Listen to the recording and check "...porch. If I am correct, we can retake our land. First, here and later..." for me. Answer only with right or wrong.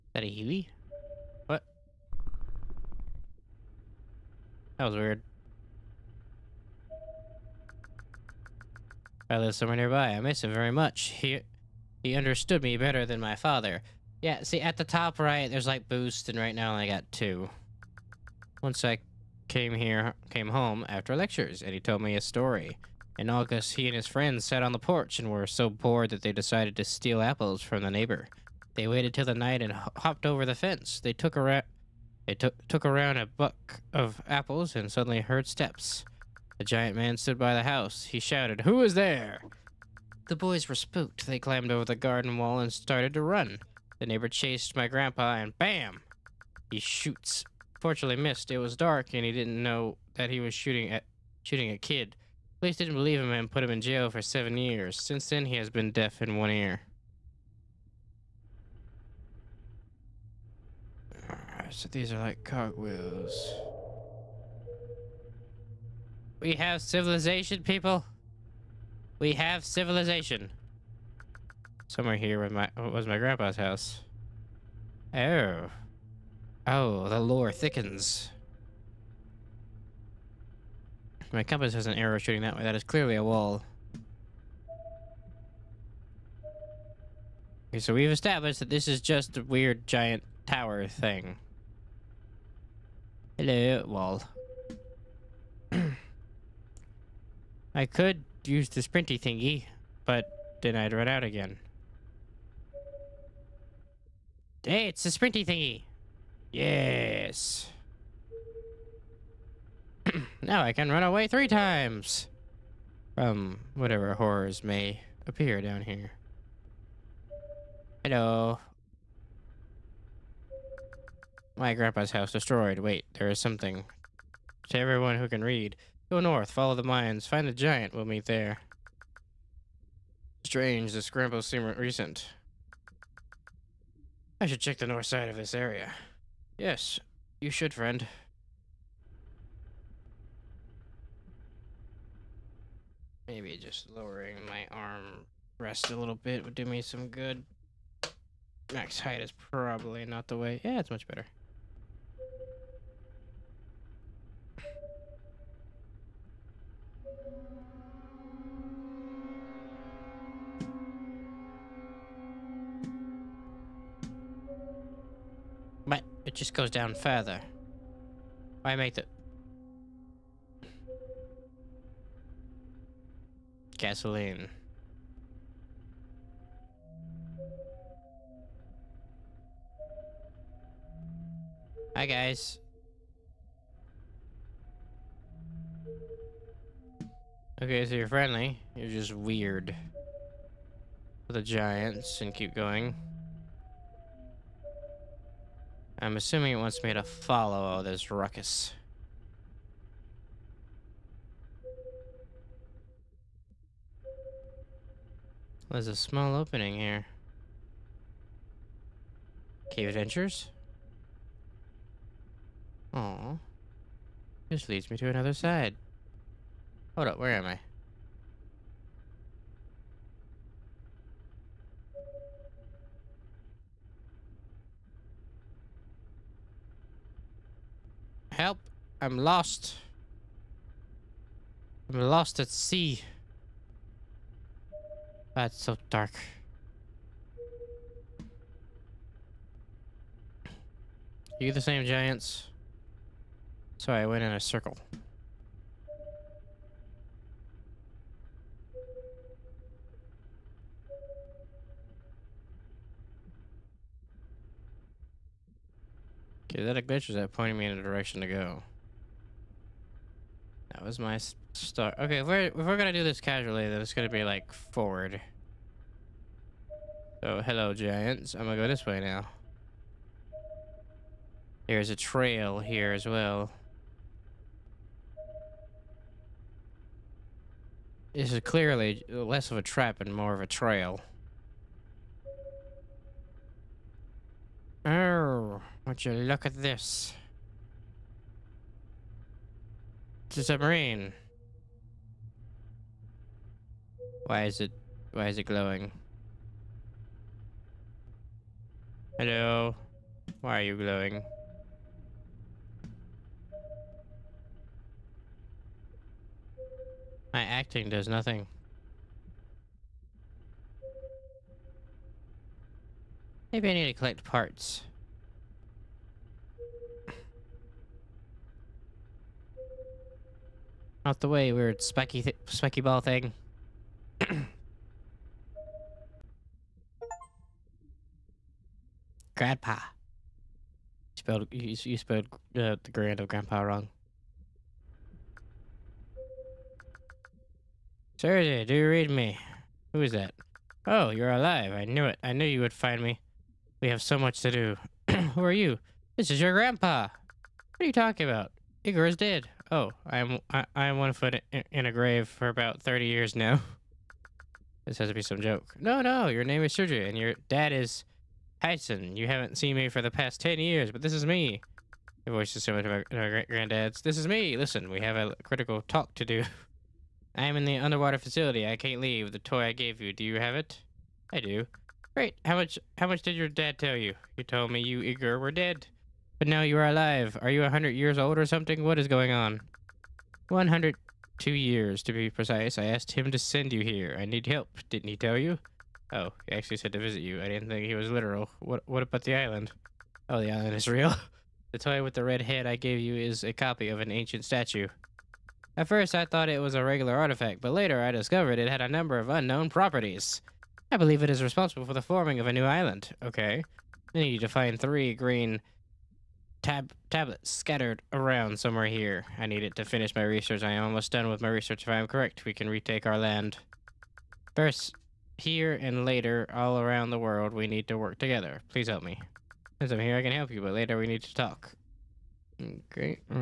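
wrong.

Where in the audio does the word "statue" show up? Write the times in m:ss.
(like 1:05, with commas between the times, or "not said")
6:34.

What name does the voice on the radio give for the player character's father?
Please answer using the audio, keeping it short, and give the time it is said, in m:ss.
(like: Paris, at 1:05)
Tyson, at 5:58.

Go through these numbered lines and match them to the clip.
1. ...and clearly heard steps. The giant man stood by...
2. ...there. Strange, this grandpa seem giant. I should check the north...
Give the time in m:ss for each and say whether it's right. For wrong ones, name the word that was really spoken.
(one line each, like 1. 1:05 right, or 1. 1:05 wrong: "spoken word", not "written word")
1. 0:34 wrong: "suddenly", not "clearly"
2. 2:08 wrong: "recent", not "giant".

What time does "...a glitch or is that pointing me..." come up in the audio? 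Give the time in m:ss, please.
4:16.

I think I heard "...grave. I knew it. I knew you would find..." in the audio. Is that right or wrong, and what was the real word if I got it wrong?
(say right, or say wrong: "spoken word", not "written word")
wrong: "alive", not "grave".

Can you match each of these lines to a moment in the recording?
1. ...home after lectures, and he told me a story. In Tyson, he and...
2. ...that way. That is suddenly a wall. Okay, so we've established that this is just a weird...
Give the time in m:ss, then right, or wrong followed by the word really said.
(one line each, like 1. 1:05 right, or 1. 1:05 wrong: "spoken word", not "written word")
1. 0:20 wrong: "August", not "Tyson"
2. 1:22 wrong: "clearly", not "suddenly".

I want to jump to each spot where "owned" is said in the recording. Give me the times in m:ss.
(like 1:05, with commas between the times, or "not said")
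not said.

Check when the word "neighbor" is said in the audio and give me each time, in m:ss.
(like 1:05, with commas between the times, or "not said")
0:27, 0:44.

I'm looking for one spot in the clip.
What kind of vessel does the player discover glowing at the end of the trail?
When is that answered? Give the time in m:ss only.
4:50.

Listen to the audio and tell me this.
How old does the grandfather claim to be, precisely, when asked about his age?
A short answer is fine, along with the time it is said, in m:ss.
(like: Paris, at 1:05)
102, at 6:20.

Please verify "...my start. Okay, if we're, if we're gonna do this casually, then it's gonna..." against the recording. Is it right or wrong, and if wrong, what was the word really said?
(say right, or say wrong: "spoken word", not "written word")
right.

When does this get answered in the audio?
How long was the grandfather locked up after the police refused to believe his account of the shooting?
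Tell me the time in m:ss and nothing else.
0:54.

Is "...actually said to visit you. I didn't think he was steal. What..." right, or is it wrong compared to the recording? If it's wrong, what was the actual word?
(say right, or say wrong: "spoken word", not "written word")
wrong: "literal", not "steal".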